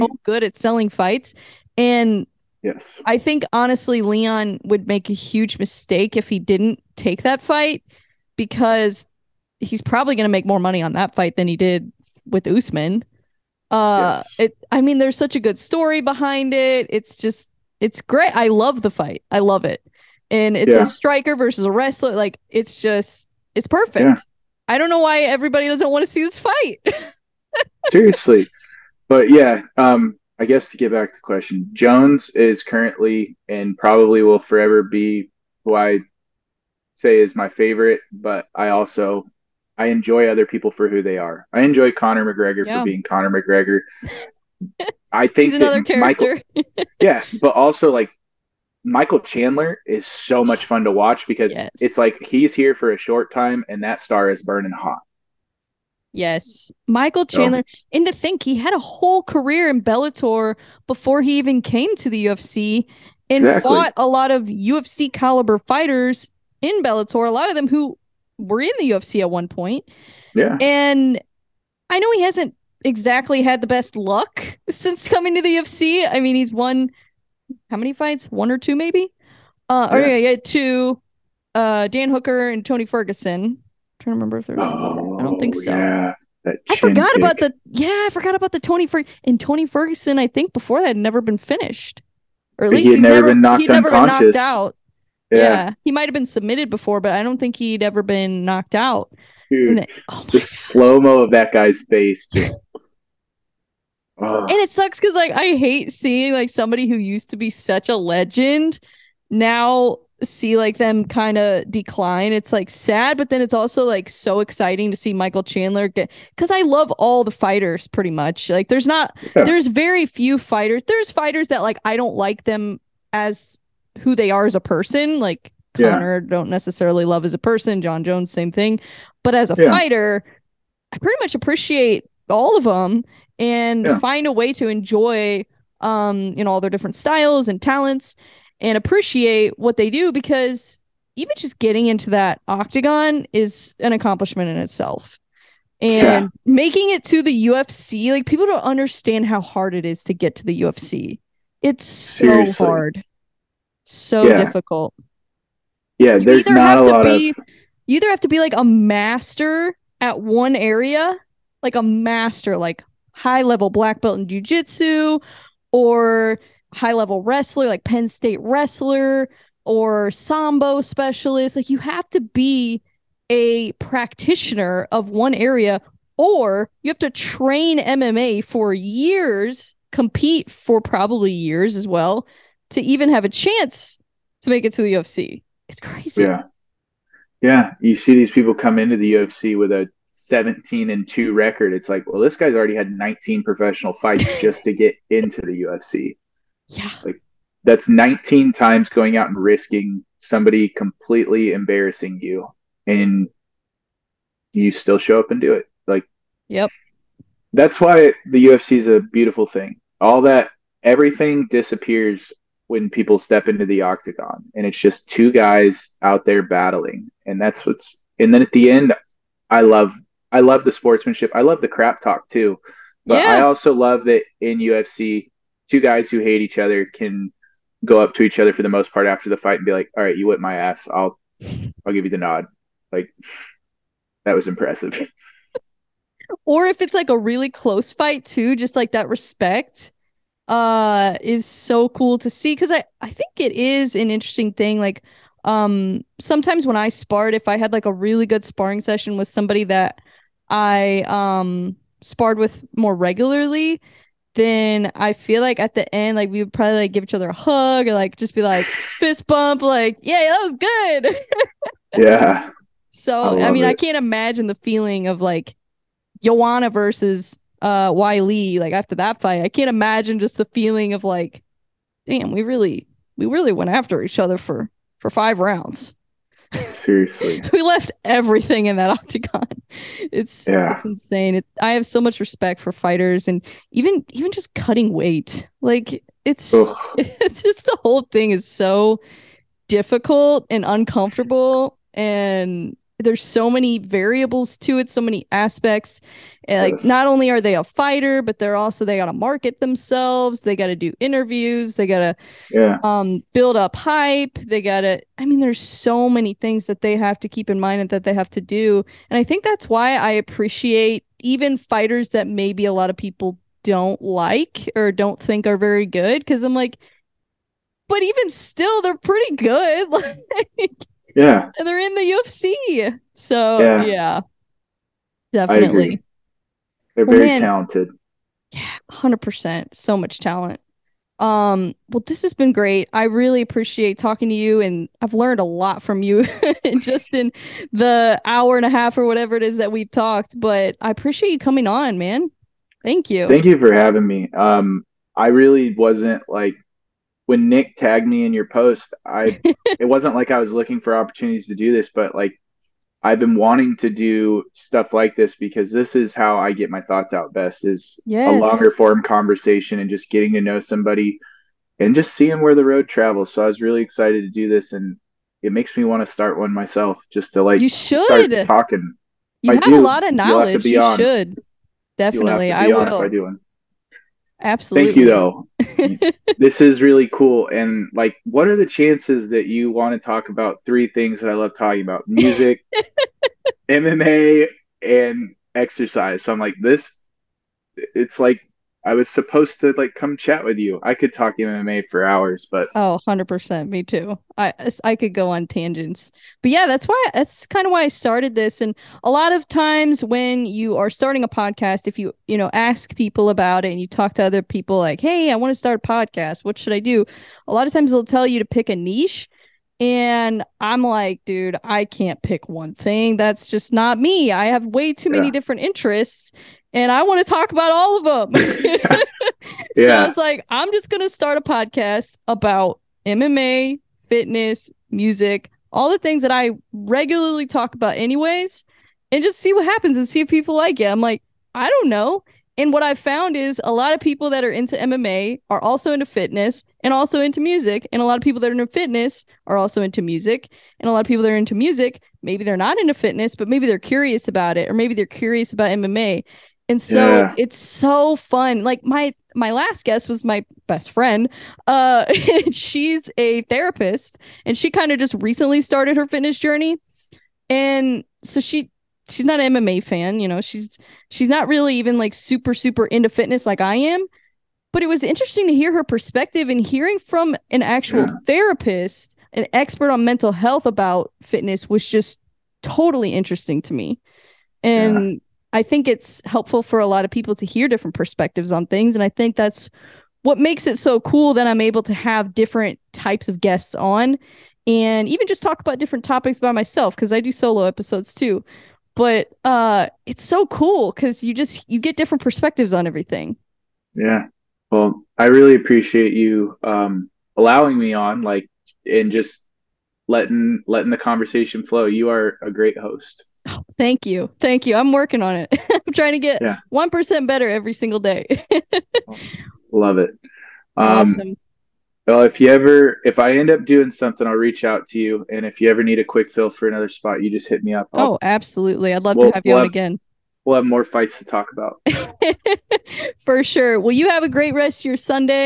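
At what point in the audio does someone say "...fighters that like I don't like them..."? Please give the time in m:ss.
2:01.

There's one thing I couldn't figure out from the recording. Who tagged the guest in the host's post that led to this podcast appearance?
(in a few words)
Nick.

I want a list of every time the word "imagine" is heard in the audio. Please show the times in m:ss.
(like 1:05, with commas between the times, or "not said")
4:23, 4:29.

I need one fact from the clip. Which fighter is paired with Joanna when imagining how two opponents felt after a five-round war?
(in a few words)
Weili.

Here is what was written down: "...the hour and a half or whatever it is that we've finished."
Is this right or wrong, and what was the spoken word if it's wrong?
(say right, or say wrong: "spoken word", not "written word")
wrong: "talked", not "finished".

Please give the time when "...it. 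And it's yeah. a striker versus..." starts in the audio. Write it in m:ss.
0:19.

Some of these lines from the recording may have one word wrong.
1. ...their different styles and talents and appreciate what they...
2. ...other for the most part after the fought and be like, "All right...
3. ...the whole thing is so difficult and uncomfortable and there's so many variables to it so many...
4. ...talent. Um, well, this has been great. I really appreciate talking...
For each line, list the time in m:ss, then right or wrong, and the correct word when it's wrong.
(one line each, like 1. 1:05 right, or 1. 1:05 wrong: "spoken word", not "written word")
1. 2:16 right
2. 3:48 wrong: "fight", not "fought"
3. 4:47 right
4. 5:30 right.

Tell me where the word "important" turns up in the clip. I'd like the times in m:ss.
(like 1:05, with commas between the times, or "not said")
not said.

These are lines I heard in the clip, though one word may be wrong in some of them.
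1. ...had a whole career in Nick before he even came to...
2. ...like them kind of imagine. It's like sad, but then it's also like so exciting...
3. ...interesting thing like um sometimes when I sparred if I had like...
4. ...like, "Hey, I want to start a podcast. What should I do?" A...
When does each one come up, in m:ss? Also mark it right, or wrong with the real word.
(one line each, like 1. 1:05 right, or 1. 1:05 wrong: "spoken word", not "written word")
1. 0:58 wrong: "Bellator", not "Nick"
2. 1:50 wrong: "decline", not "imagine"
3. 4:04 right
4. 6:44 right.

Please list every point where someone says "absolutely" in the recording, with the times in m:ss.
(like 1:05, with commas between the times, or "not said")
6:14, 8:38.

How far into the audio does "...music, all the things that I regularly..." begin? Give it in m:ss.
7:04.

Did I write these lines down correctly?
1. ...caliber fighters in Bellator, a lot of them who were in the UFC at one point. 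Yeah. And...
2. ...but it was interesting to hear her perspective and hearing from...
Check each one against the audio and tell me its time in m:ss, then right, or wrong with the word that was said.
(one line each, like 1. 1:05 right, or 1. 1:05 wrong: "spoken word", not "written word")
1. 1:05 right
2. 7:44 right.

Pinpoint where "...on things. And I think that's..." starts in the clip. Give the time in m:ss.
7:58.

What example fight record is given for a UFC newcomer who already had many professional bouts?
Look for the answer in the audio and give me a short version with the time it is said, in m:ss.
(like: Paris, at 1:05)
17 and 2, at 3:10.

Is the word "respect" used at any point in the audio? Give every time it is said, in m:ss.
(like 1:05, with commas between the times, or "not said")
3:59, 4:42.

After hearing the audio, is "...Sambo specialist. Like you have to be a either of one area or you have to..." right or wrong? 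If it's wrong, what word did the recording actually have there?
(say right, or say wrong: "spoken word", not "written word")
wrong: "practitioner", not "either".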